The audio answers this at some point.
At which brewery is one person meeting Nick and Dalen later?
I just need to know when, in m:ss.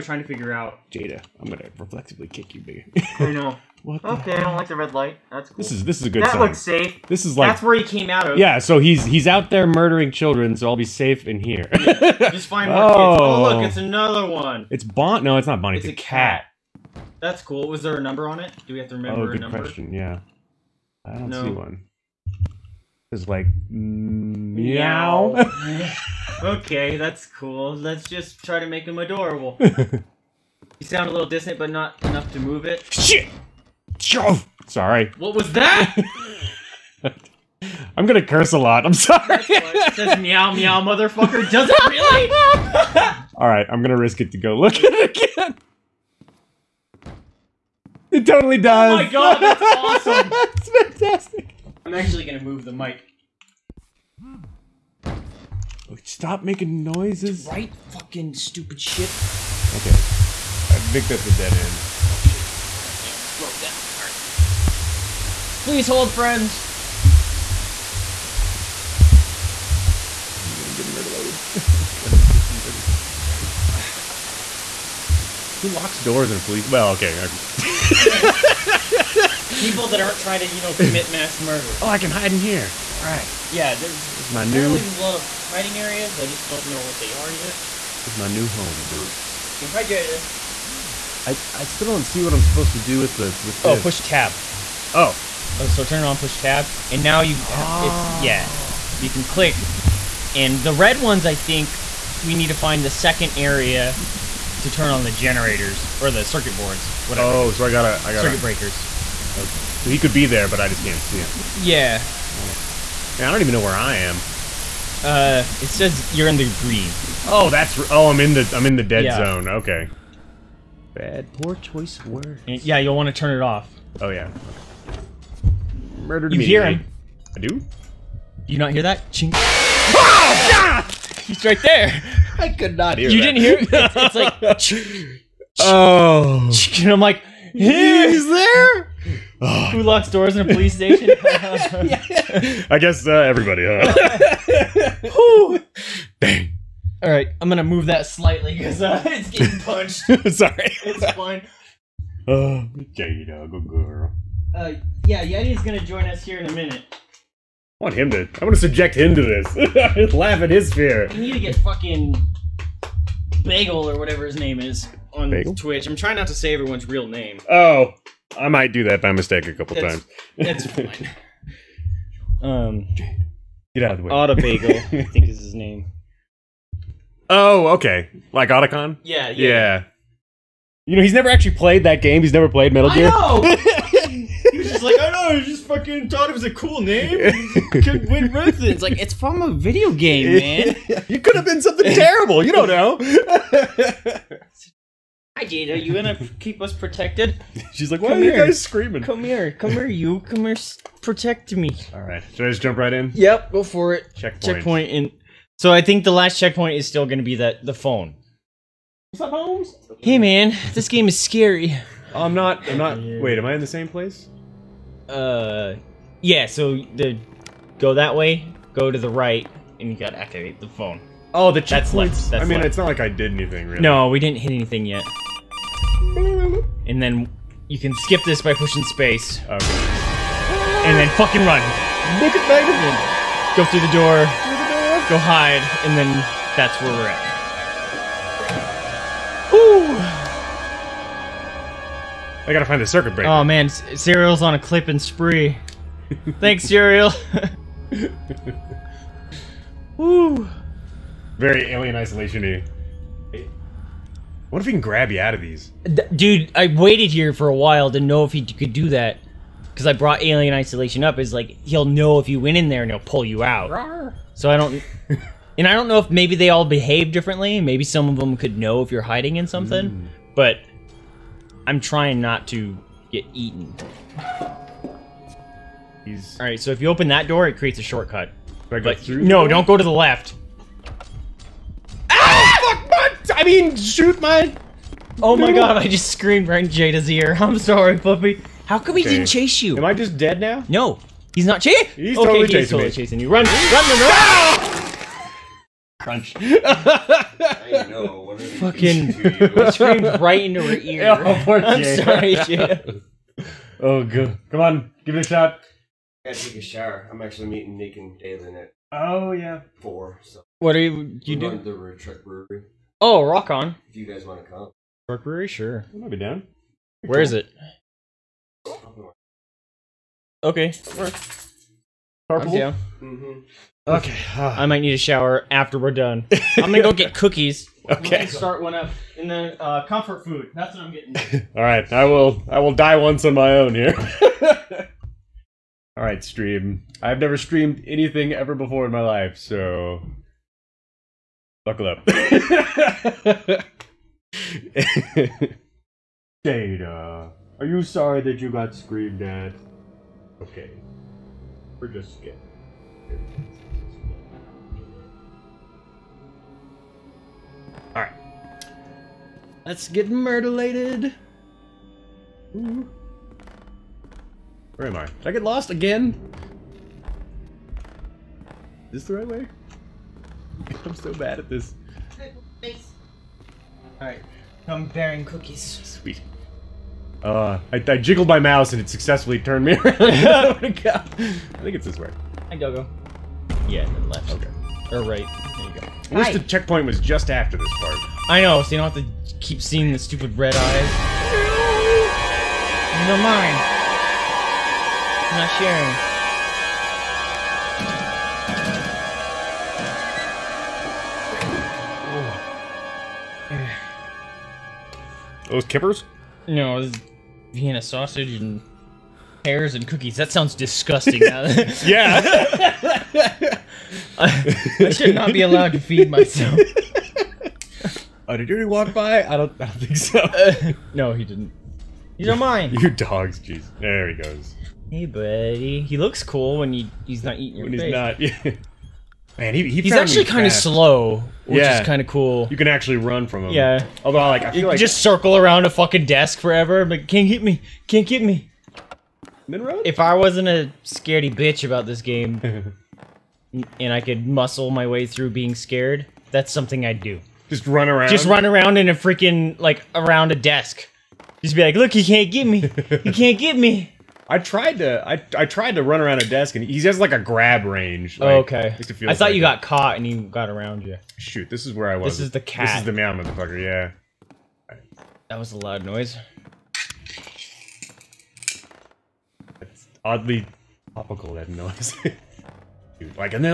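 5:11.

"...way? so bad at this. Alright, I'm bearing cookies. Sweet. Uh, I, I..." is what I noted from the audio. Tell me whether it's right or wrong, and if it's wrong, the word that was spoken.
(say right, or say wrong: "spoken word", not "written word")
right.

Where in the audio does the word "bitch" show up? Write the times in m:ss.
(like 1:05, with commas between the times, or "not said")
7:21.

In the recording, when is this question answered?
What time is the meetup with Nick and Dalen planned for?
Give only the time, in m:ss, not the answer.
5:09.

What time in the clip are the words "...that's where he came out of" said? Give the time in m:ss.
0:07.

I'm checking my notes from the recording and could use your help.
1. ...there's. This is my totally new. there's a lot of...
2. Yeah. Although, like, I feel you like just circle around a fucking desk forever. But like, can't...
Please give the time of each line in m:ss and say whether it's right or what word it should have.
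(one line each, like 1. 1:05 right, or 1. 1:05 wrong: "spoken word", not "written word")
1. 1:23 wrong: "apparently", not "totally"
2. 7:13 right.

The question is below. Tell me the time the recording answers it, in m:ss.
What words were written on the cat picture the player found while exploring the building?
0:40.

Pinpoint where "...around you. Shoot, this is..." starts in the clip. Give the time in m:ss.
7:40.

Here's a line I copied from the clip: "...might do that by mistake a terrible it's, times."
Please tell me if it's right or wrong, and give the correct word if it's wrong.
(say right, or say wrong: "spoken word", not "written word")
wrong: "couple", not "terrible".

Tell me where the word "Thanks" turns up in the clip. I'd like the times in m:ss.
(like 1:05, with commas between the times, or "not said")
4:06.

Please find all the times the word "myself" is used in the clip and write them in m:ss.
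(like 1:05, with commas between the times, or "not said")
6:56.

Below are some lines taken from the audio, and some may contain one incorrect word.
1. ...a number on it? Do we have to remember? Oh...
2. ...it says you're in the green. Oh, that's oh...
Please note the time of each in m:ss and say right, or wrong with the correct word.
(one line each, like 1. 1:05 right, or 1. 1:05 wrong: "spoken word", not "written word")
1. 0:17 right
2. 1:55 right.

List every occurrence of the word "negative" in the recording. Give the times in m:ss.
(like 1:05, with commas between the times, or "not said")
not said.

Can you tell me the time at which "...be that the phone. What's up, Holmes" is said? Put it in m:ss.
3:27.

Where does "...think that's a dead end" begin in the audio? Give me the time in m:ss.
1:00.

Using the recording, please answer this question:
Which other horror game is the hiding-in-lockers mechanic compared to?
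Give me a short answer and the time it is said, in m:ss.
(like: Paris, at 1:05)
Alien Isolation, at 4:20.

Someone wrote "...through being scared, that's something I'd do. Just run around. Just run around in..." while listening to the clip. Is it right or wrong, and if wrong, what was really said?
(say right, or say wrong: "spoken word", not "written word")
right.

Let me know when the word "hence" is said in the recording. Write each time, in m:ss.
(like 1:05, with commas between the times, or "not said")
not said.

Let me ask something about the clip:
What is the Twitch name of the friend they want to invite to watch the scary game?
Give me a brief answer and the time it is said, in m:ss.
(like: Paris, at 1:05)
Autobagel, at 2:54.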